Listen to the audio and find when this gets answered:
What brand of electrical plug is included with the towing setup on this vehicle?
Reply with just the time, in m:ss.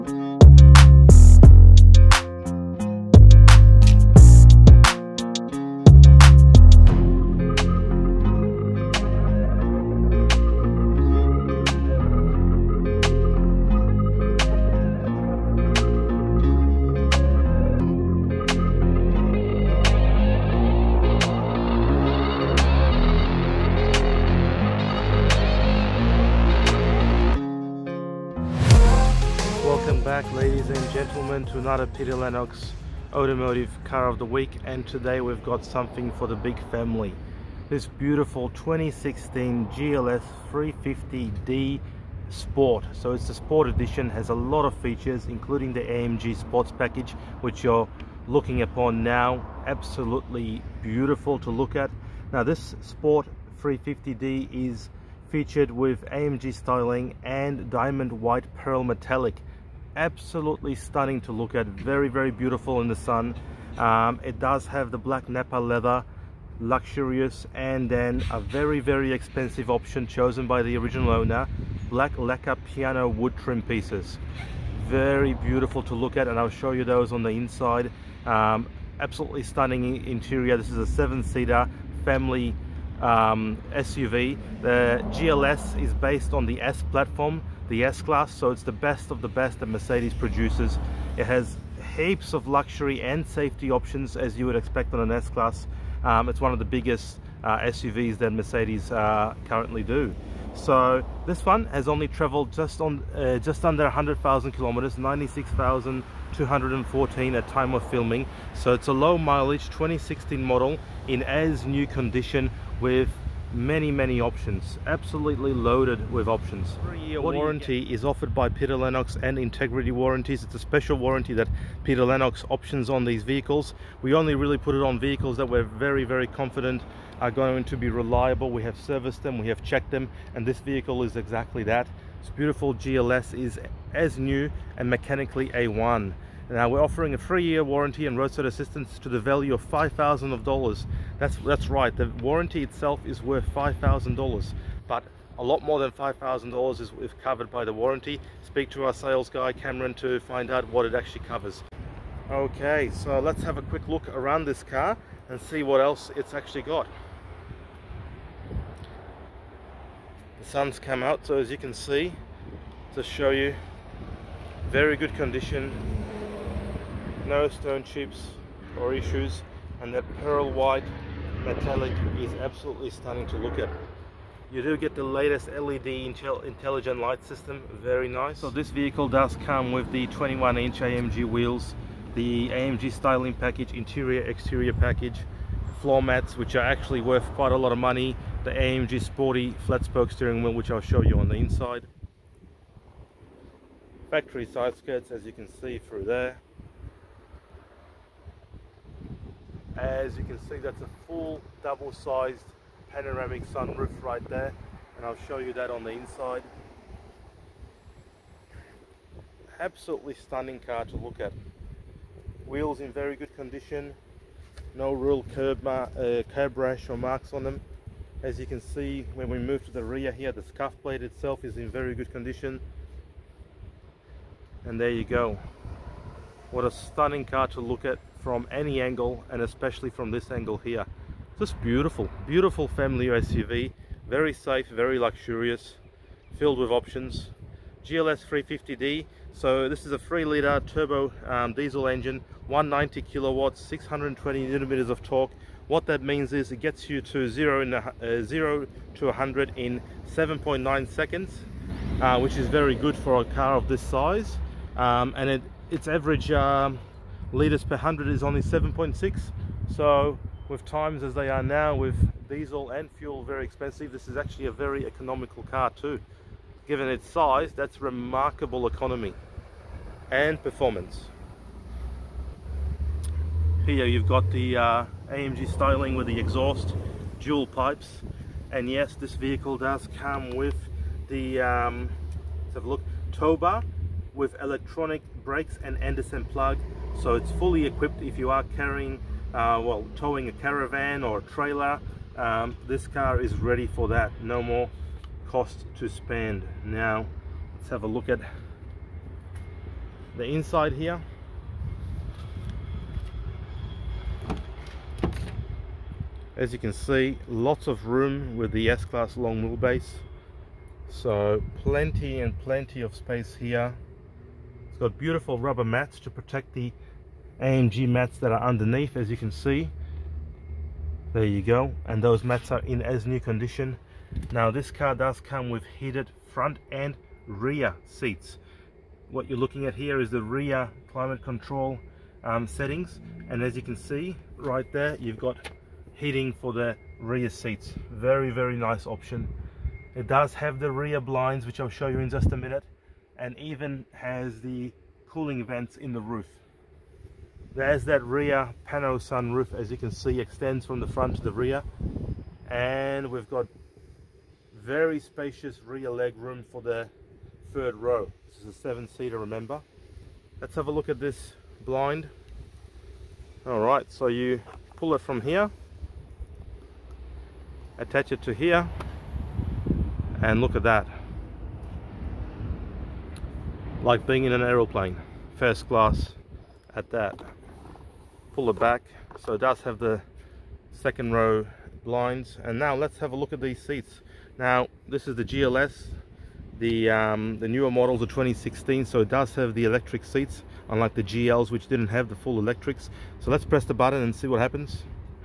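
4:45.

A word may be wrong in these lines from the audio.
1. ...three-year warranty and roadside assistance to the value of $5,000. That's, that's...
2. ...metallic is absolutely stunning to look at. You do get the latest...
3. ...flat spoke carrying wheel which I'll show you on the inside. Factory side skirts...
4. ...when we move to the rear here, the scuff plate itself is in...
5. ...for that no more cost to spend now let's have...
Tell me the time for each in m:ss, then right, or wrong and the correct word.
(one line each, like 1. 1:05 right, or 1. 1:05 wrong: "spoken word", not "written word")
1. 2:17 right
2. 2:51 right
3. 3:09 wrong: "steering", not "carrying"
4. 3:39 right
5. 4:53 right.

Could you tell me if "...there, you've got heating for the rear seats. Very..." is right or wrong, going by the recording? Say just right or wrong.
right.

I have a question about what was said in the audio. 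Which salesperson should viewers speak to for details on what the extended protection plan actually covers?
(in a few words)
Cameron.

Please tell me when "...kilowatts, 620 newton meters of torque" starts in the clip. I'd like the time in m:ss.
4:03.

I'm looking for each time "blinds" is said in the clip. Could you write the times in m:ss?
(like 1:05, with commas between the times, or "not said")
5:40, 6:01, 6:21.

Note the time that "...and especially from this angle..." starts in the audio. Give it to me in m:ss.
3:49.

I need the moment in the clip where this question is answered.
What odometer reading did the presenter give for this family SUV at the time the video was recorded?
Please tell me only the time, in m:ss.
1:44.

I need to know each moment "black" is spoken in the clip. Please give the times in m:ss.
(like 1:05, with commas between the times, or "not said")
1:04, 1:11.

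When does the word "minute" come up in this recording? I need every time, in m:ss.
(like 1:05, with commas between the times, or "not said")
5:42.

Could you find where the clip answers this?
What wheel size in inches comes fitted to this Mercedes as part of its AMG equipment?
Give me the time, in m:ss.
3:00.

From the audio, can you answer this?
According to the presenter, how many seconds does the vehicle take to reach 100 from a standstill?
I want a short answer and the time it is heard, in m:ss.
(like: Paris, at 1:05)
7.9 seconds, at 4:10.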